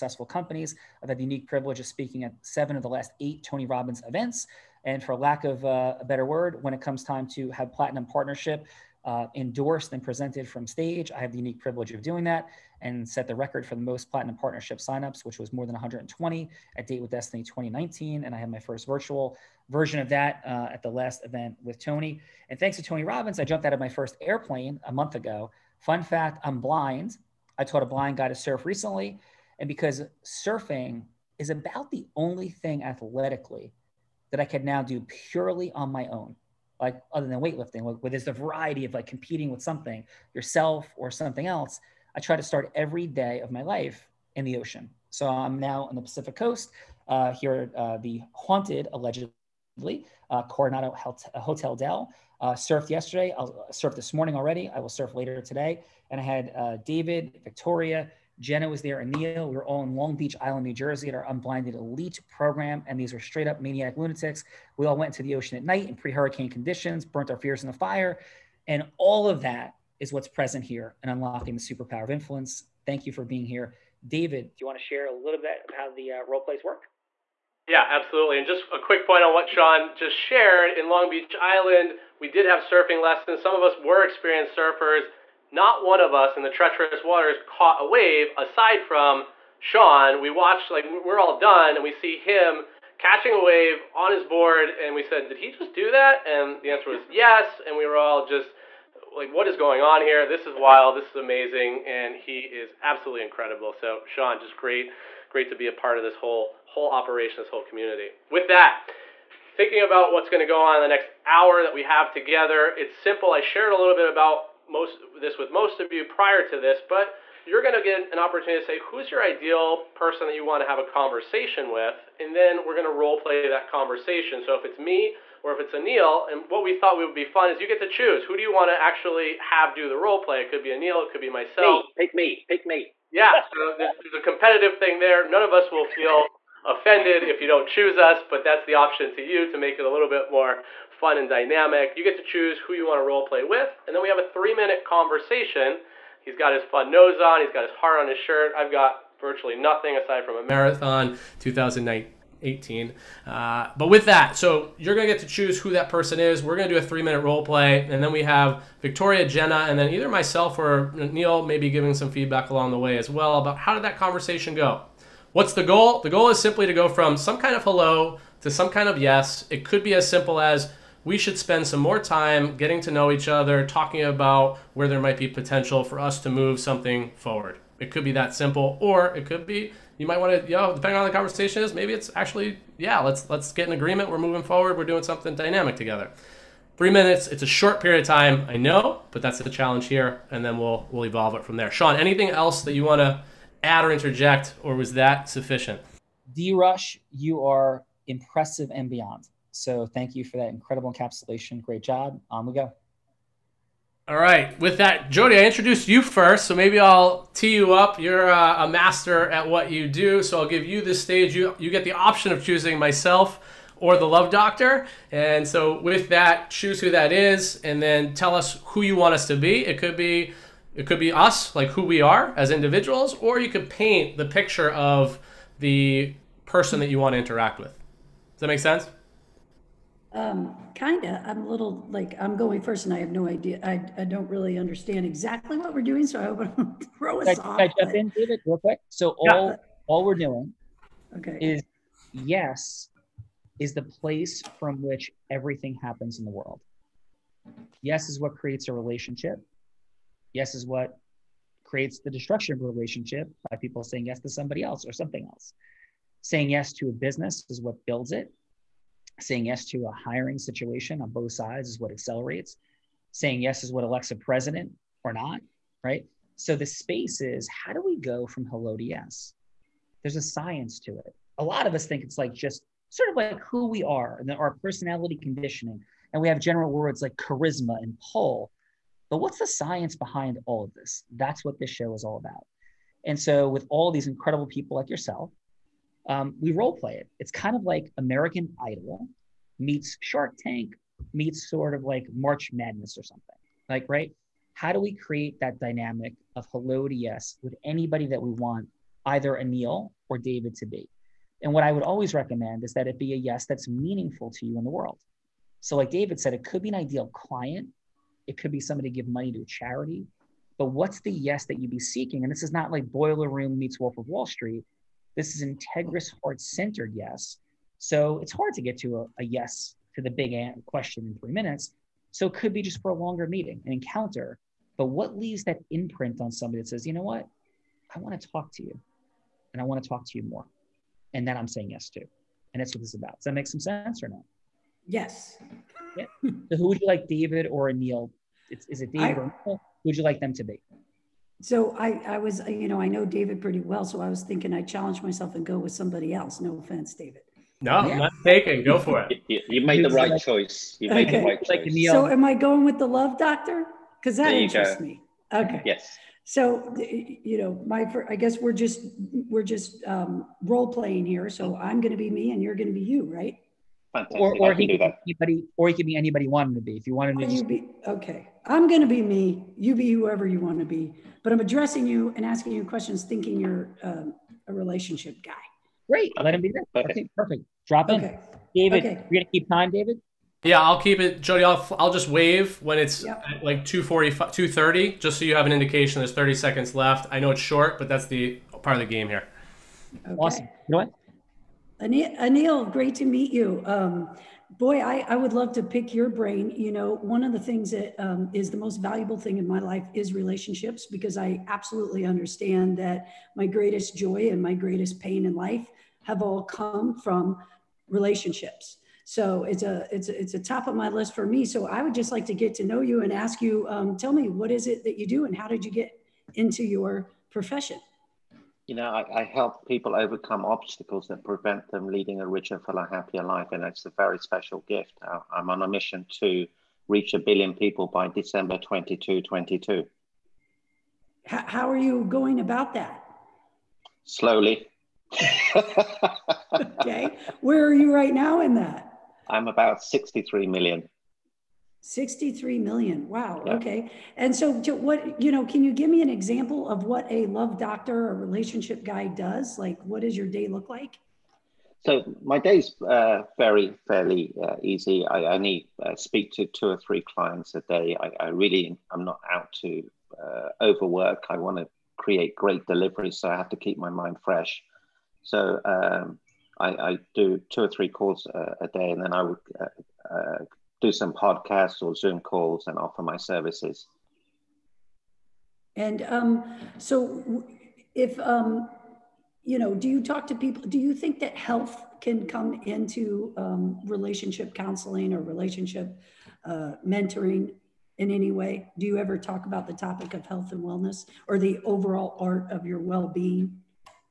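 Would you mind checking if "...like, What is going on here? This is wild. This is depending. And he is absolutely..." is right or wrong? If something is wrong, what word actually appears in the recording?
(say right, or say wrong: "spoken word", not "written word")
wrong: "amazing", not "depending".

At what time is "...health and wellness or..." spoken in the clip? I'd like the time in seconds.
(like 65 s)
490 s.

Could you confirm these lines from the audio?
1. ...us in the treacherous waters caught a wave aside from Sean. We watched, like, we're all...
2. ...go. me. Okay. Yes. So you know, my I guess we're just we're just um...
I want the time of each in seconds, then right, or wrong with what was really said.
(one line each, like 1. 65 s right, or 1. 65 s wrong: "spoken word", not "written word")
1. 86 s right
2. 354 s right.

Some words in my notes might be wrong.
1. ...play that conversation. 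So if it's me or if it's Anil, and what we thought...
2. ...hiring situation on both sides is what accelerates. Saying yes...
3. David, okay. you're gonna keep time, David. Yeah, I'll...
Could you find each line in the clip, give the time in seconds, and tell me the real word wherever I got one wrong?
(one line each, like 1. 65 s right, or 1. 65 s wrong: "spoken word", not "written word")
1. 123 s right
2. 259 s right
3. 378 s right.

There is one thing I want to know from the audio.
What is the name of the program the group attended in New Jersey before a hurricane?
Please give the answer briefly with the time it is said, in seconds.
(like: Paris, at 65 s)
Unblinded Elite, at 61 s.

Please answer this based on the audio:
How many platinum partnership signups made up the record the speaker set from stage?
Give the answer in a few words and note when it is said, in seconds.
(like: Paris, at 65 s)
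more than 120, at 15 s.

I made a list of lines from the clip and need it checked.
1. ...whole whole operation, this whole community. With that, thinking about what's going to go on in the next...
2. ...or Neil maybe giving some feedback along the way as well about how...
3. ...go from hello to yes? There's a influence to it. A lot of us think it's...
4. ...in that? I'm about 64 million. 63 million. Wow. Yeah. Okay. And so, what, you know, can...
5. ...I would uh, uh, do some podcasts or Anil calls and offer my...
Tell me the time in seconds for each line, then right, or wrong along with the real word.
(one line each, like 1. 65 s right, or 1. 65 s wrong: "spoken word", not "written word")
1. 106 s right
2. 160 s right
3. 267 s wrong: "science", not "influence"
4. 438 s wrong: "63", not "64"
5. 469 s wrong: "Zoom", not "Anil".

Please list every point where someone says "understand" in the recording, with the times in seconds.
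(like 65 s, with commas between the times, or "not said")
234 s, 402 s.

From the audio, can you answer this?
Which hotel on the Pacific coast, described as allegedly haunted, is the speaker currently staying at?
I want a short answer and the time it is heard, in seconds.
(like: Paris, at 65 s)
Coronado Hotel Del, at 50 s.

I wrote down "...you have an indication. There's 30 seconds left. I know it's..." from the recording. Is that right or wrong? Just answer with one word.
right.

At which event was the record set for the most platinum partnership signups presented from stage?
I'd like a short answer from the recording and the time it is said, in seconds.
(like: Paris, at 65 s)
Date with Destiny 2019, at 16 s.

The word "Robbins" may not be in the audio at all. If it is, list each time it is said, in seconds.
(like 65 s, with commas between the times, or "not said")
3 s, 23 s.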